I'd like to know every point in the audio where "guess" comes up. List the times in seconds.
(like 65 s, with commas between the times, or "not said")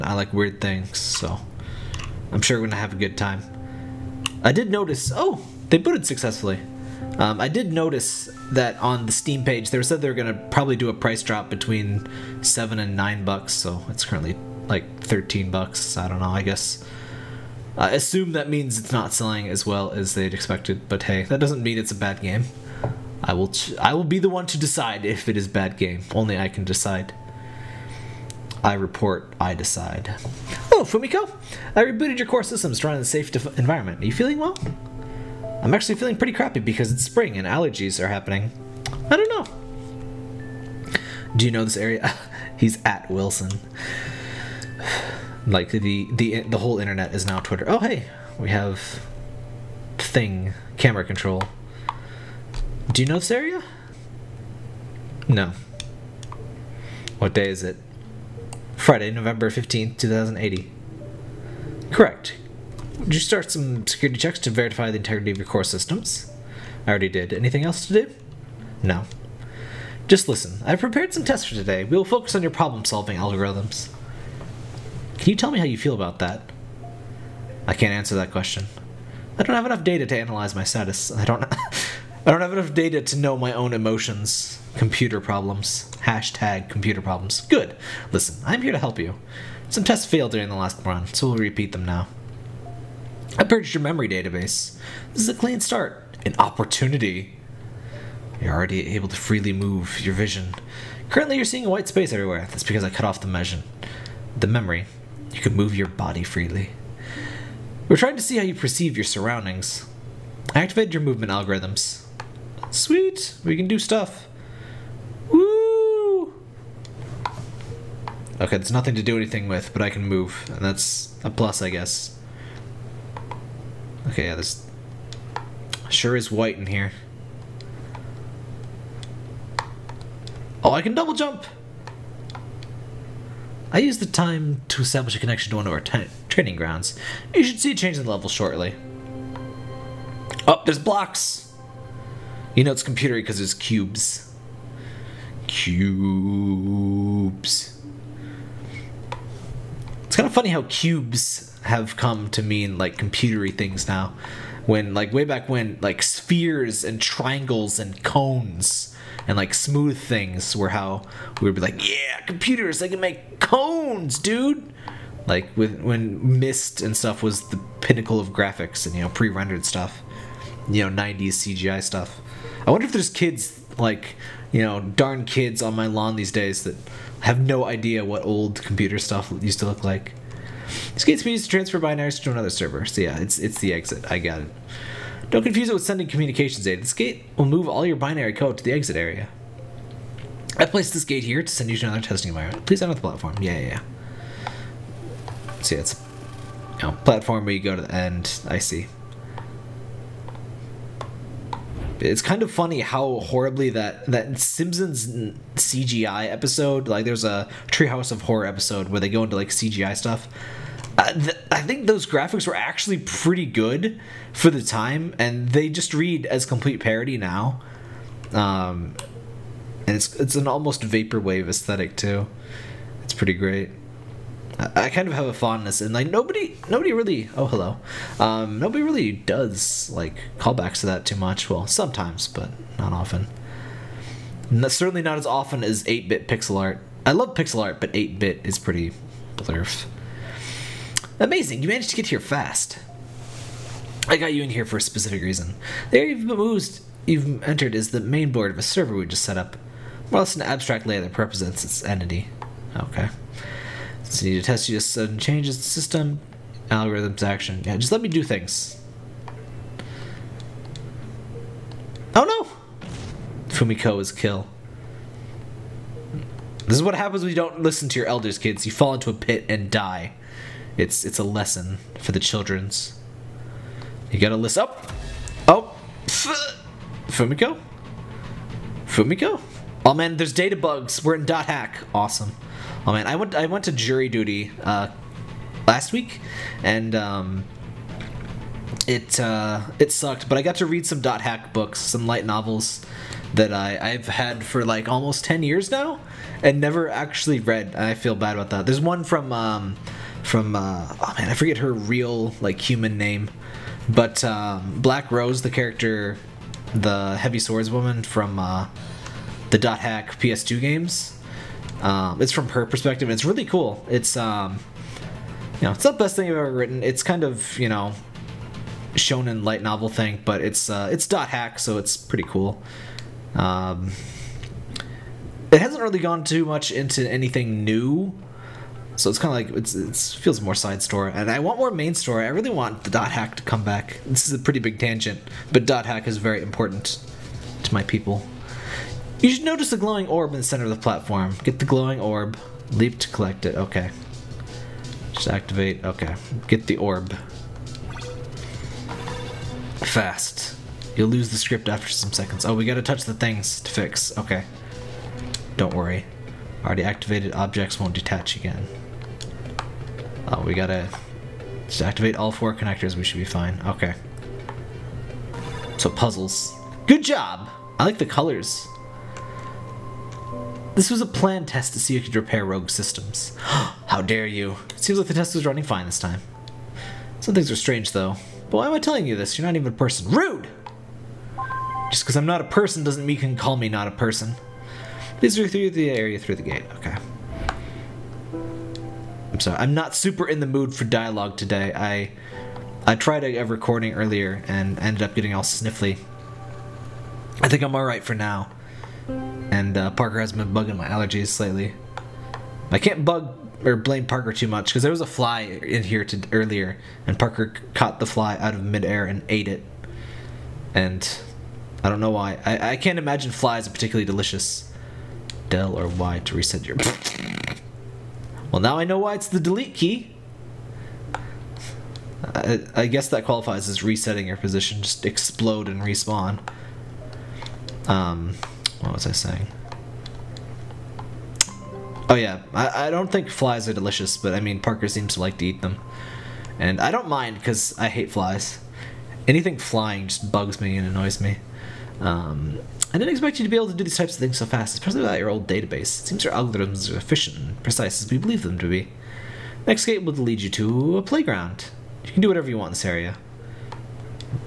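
16 s, 121 s, 422 s.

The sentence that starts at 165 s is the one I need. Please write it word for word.
Like with when Myst and stuff was the pinnacle of graphics and you know pre-rendered stuff, you know 90s CGI stuff.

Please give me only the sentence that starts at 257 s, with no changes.
Yeah, just let me do things.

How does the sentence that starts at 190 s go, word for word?
I placed this gate here to send you to another testing environment.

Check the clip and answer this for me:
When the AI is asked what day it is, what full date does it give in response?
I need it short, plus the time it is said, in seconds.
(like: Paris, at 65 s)
Friday, November 15th, 2080, at 58 s.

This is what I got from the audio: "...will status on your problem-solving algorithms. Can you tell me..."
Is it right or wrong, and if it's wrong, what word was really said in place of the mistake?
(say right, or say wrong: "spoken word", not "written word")
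wrong: "focus", not "status".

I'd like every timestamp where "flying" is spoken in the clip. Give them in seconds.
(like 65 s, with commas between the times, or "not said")
439 s.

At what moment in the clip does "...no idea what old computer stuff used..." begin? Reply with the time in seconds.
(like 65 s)
177 s.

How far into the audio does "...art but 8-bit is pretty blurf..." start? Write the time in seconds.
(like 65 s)
237 s.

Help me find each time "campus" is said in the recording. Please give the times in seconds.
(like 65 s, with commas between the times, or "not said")
not said.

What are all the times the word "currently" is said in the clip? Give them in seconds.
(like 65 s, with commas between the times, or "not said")
14 s, 101 s.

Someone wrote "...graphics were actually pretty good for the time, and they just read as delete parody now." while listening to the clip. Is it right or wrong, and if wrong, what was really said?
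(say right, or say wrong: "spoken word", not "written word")
wrong: "complete", not "delete".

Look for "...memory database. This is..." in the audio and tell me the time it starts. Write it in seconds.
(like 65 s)
93 s.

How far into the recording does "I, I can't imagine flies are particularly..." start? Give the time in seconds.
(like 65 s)
412 s.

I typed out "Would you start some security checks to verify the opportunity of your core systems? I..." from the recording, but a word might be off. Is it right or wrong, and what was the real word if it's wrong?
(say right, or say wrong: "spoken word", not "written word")
wrong: "integrity", not "opportunity".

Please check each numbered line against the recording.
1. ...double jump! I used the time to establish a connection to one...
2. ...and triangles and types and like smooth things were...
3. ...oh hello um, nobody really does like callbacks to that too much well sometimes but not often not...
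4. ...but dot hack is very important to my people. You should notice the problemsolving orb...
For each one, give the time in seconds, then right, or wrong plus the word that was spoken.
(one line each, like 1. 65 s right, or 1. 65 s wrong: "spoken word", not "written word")
1. 130 s right
2. 156 s wrong: "cones", not "types"
3. 227 s right
4. 335 s wrong: "glowing", not "problemsolving".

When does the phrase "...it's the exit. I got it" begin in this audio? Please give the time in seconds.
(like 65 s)
183 s.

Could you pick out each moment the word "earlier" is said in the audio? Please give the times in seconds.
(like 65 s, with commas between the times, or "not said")
393 s, 406 s.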